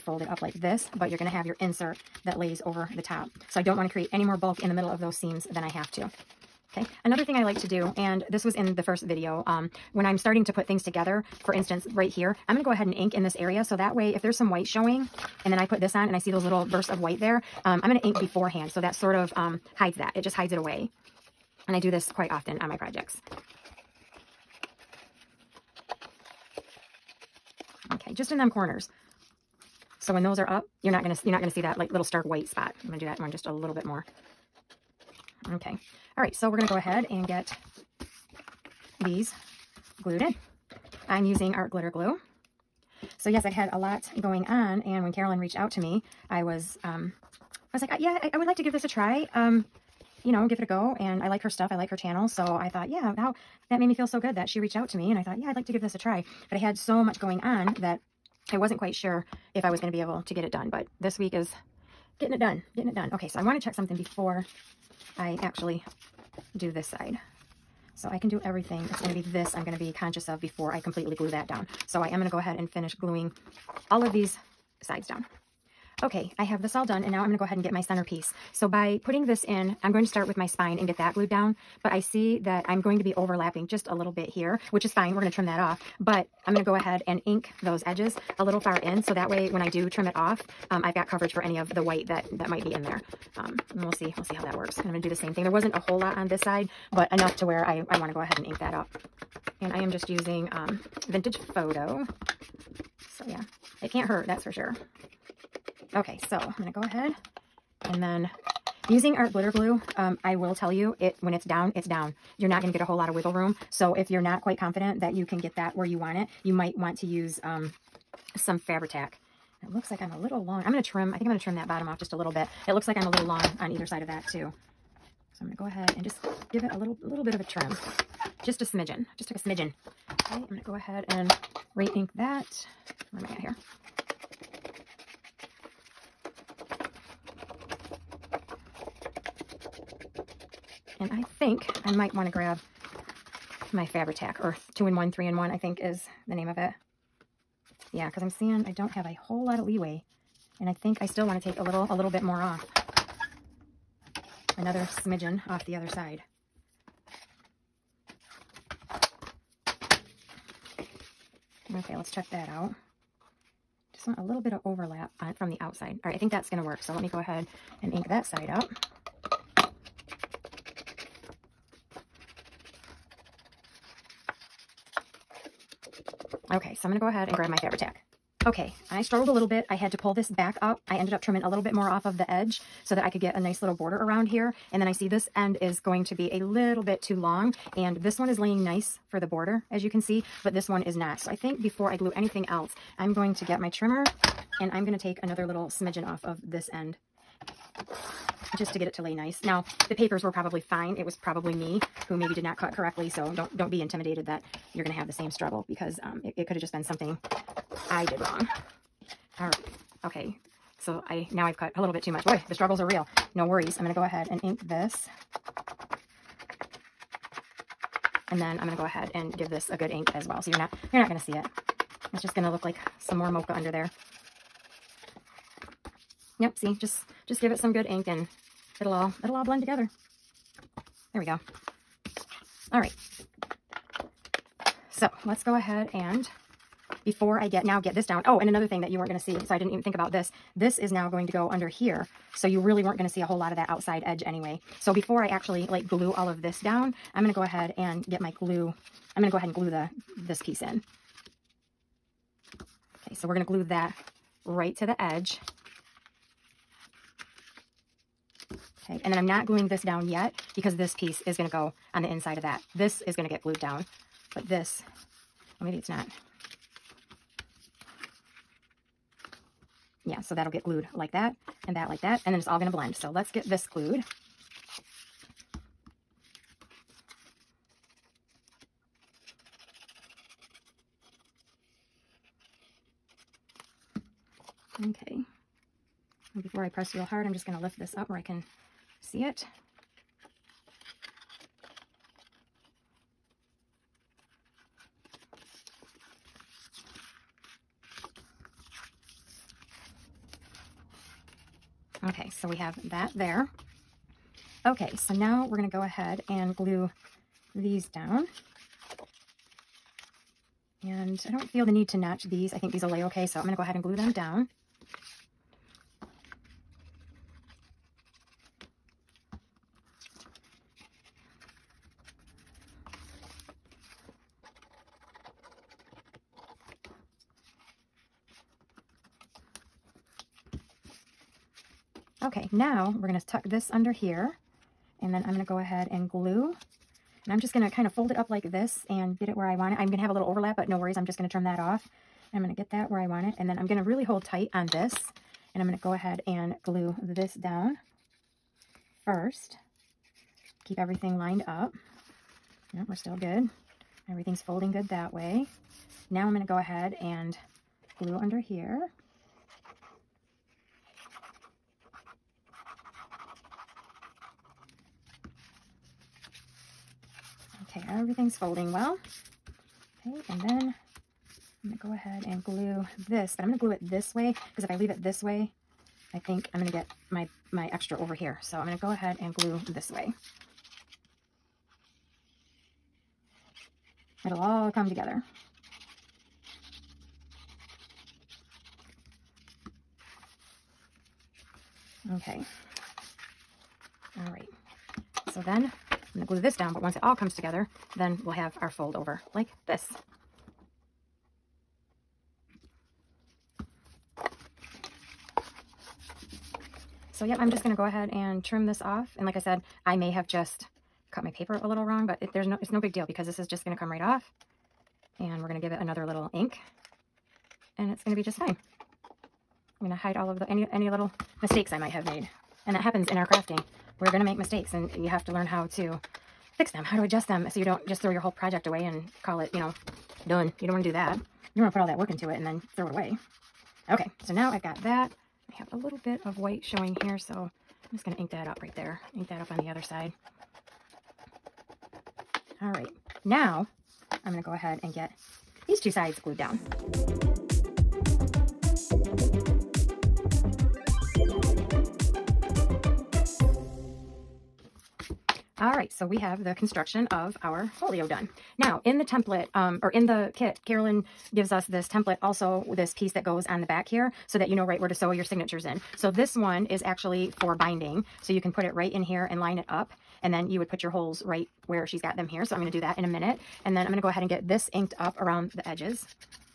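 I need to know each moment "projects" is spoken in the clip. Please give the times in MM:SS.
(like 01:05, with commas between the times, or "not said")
00:22, 07:08.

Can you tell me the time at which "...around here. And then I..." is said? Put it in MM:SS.
03:03.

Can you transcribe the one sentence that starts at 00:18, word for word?
So that sort of um, hides that.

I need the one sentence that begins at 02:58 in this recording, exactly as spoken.
Okay, I struggled a little bit.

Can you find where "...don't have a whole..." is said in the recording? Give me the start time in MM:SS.
02:28.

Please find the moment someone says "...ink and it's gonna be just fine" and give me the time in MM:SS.
06:56.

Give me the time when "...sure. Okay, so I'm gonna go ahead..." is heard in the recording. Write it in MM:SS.
01:44.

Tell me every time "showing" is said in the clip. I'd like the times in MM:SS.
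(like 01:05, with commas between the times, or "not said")
00:14, 07:16.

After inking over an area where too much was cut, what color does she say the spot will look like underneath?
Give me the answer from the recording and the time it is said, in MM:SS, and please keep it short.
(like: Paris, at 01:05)
mocha, at 03:43.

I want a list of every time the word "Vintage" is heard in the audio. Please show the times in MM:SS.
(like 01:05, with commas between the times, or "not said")
01:41.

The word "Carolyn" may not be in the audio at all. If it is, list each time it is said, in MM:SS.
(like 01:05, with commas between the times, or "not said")
00:45, 07:40.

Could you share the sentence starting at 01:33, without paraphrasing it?
Um, we'll see, we'll see how that works.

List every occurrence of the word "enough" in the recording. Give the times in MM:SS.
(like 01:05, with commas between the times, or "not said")
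01:37.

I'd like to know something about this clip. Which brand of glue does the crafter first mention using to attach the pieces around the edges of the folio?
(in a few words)
Art Glitter Glue.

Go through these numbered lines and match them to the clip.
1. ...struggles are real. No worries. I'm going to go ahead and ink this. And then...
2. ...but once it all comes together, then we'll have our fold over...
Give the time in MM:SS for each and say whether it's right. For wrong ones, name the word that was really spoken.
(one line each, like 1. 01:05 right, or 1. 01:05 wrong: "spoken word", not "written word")
1. 03:32 right
2. 06:36 right.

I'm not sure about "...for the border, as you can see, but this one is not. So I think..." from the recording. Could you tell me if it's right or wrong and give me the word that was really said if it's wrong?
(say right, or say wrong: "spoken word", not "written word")
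right.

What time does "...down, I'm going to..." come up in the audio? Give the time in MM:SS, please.
04:06.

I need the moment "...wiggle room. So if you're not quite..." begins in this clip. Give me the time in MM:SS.
01:53.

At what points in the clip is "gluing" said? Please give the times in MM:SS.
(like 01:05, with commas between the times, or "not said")
01:12, 04:19.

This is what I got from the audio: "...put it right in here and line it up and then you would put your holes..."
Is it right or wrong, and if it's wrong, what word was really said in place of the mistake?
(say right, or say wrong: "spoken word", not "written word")
right.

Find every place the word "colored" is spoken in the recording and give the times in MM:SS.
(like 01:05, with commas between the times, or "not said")
not said.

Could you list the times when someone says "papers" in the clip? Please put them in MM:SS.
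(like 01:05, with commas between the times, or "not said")
03:19, 06:51.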